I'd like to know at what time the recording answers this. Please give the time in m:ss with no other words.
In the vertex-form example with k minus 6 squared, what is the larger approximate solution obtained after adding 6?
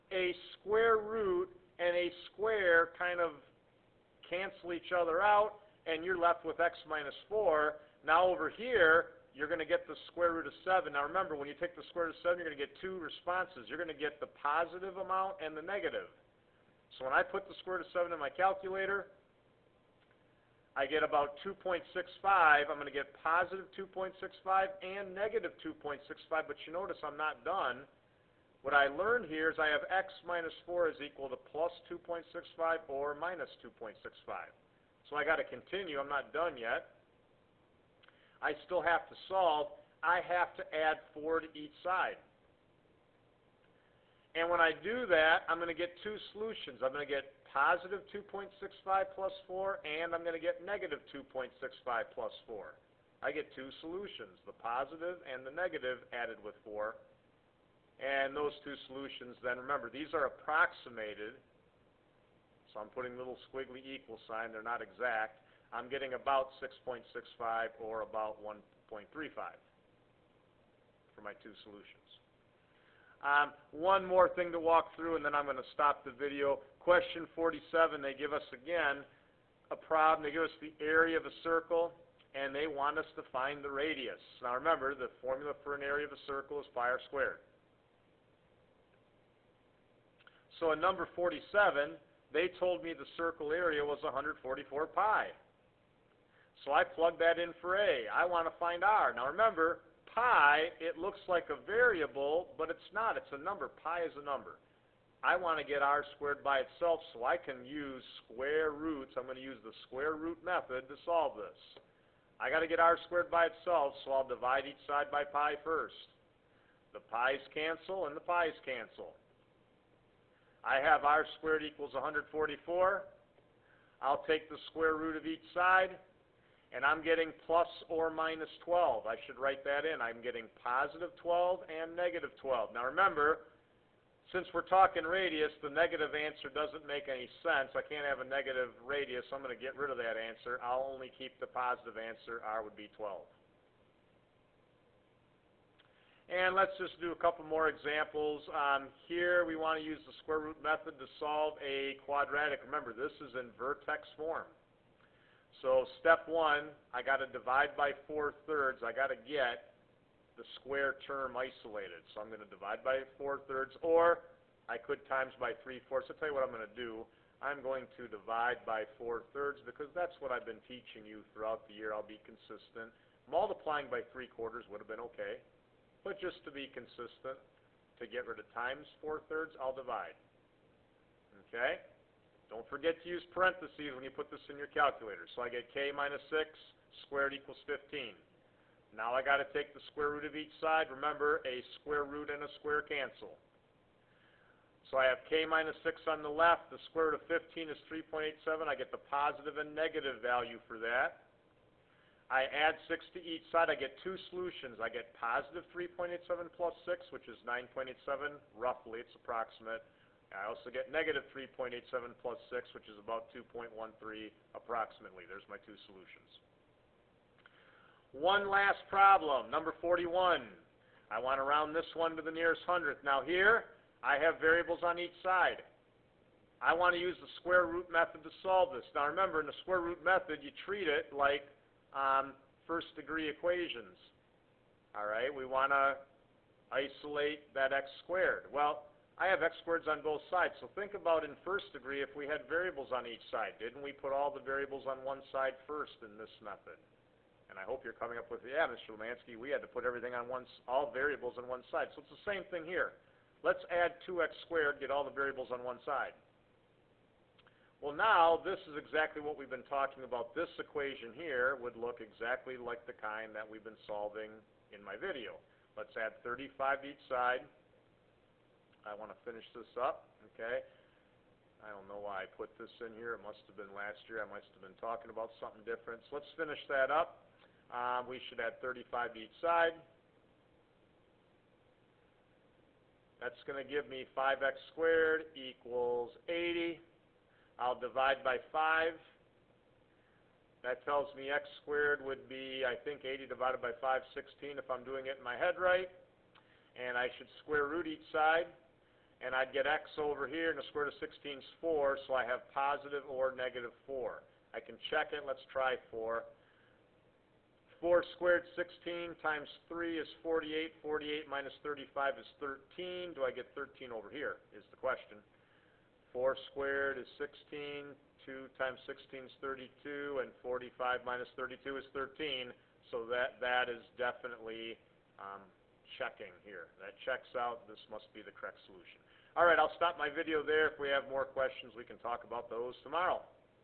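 3:27.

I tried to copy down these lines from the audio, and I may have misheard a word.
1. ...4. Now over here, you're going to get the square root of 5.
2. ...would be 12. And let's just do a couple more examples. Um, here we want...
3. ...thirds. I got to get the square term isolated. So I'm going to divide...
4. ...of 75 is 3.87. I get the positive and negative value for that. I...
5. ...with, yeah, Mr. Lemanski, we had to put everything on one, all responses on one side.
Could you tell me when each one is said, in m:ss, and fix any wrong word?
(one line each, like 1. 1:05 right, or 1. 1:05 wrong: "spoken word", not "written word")
1. 0:07 wrong: "7", not "5"
2. 2:22 right
3. 2:38 right
4. 3:17 wrong: "15", not "75"
5. 4:08 wrong: "variables", not "responses".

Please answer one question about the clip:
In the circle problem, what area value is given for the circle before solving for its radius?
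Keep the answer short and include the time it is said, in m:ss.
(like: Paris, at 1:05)
144 pi, at 1:34.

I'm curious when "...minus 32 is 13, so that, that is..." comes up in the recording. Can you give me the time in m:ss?
5:21.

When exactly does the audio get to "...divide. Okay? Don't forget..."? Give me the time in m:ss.
2:59.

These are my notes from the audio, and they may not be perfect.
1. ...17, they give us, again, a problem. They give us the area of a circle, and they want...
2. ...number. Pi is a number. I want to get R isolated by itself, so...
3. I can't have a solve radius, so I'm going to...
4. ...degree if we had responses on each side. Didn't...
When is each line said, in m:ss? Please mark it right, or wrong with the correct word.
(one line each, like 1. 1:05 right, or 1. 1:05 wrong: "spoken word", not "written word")
1. 1:17 wrong: "47", not "17"
2. 1:43 wrong: "squared", not "isolated"
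3. 2:17 wrong: "negative", not "solve"
4. 4:01 wrong: "variables", not "responses".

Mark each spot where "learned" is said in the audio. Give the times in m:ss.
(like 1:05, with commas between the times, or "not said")
0:28.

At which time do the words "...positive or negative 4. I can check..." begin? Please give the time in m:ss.
5:02.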